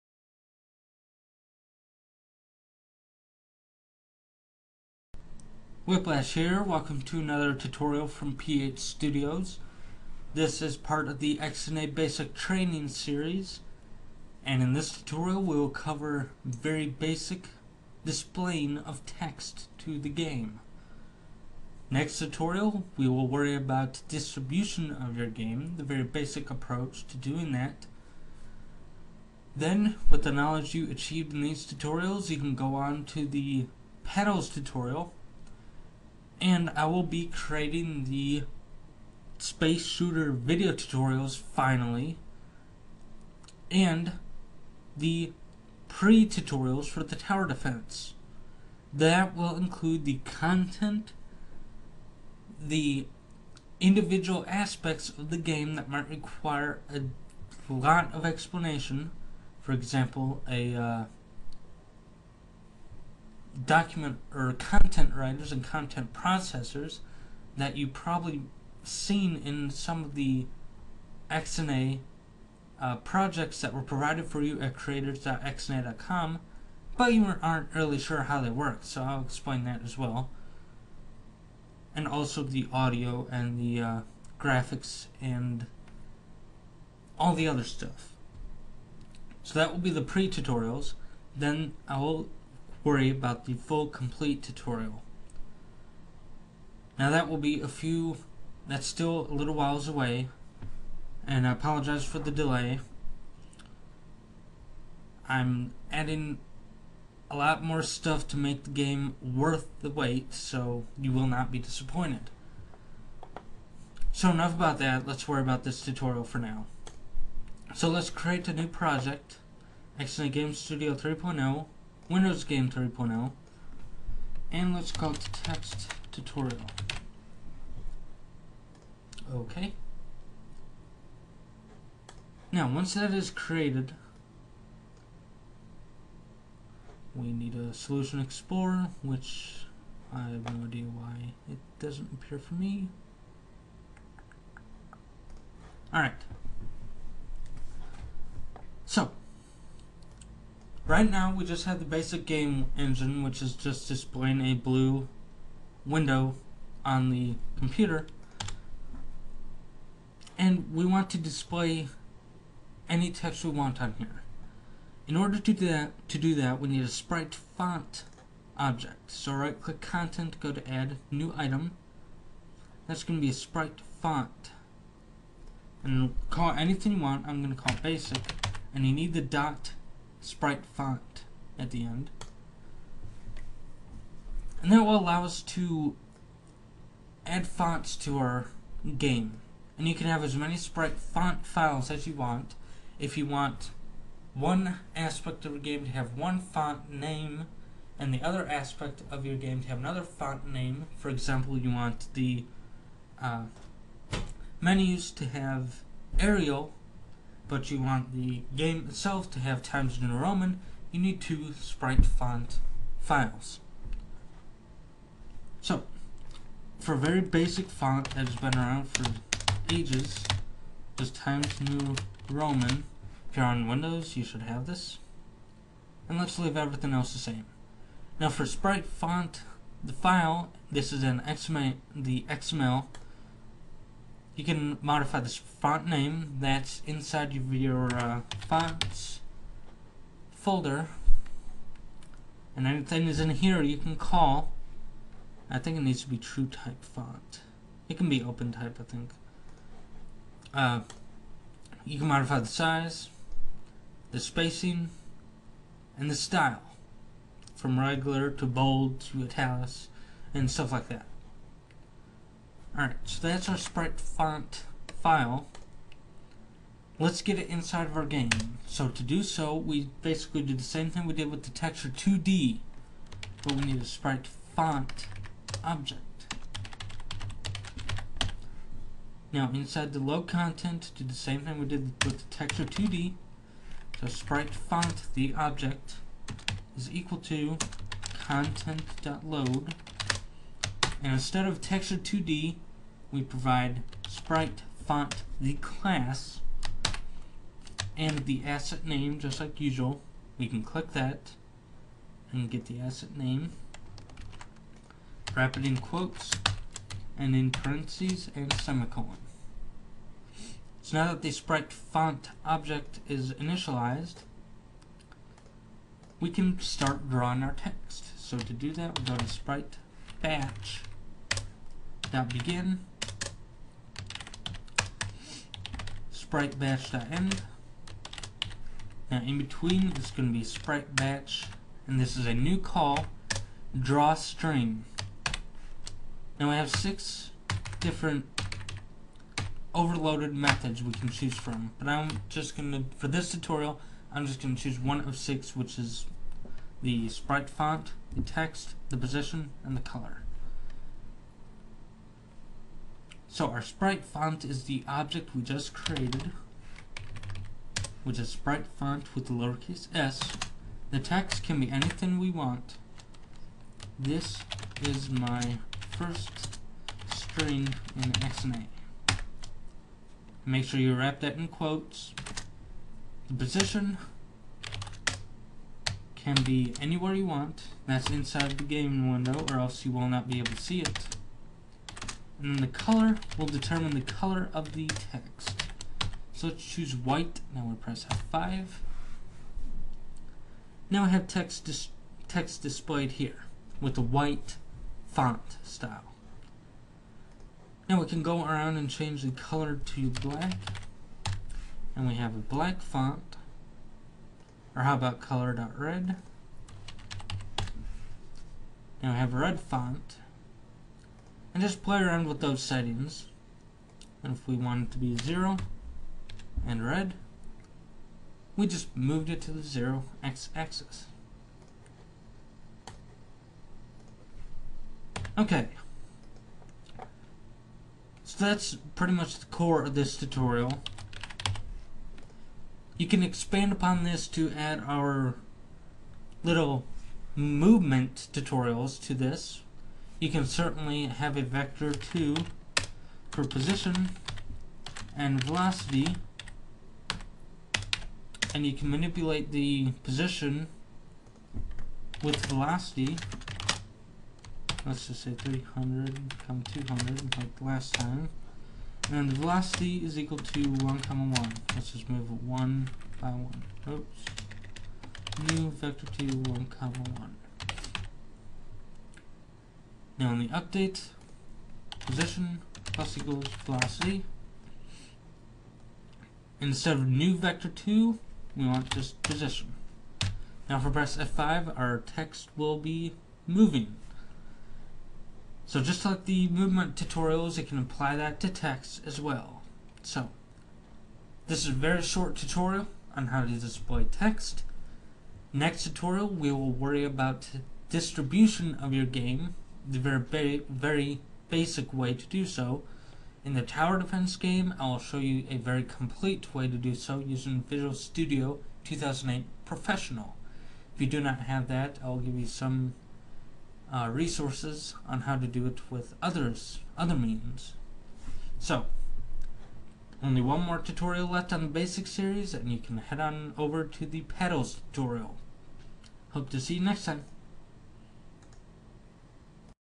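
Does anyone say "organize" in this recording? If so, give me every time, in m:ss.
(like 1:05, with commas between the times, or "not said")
not said.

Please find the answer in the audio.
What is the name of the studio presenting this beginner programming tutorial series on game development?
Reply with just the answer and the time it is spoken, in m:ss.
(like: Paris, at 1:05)
PH Studios, at 0:08.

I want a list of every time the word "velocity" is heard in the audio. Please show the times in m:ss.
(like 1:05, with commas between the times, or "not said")
7:25, 7:32, 7:39, 7:53.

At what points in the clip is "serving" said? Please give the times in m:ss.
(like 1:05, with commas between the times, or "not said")
not said.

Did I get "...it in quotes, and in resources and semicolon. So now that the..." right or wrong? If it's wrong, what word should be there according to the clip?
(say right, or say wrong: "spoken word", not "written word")
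wrong: "parentheses", not "resources".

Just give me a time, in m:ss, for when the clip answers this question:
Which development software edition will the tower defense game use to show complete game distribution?
8:27.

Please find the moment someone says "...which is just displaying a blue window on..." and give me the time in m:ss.
2:33.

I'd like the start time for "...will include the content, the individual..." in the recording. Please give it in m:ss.
0:49.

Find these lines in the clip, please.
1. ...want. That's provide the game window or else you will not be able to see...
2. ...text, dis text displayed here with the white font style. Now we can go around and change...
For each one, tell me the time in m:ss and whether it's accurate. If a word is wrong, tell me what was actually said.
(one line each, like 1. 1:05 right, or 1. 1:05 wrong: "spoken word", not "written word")
1. 6:17 wrong: "inside", not "provide"
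2. 6:31 right.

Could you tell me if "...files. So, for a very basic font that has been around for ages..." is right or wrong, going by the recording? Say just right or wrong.
right.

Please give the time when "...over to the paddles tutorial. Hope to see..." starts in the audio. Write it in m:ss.
8:43.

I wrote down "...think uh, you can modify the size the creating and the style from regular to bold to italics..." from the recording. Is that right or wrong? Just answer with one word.
wrong.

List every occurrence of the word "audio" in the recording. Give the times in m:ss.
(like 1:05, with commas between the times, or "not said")
1:22.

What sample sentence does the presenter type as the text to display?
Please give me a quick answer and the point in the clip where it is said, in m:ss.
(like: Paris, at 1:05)
This is my first string in XNA, at 6:03.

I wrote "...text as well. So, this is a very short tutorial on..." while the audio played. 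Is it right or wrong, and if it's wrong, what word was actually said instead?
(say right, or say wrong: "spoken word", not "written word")
right.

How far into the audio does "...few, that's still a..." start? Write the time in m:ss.
1:37.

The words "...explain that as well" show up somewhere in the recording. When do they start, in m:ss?
1:19.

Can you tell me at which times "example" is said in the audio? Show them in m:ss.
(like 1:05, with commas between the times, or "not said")
0:59, 3:21.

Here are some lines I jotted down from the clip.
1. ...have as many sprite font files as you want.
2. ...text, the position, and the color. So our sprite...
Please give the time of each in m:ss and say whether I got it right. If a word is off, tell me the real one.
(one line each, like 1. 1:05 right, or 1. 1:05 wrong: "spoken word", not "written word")
1. 3:10 right
2. 5:48 right.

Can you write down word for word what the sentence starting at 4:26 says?
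Let's get it inside of our game.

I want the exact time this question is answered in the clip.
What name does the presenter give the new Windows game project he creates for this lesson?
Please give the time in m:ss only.
2:05.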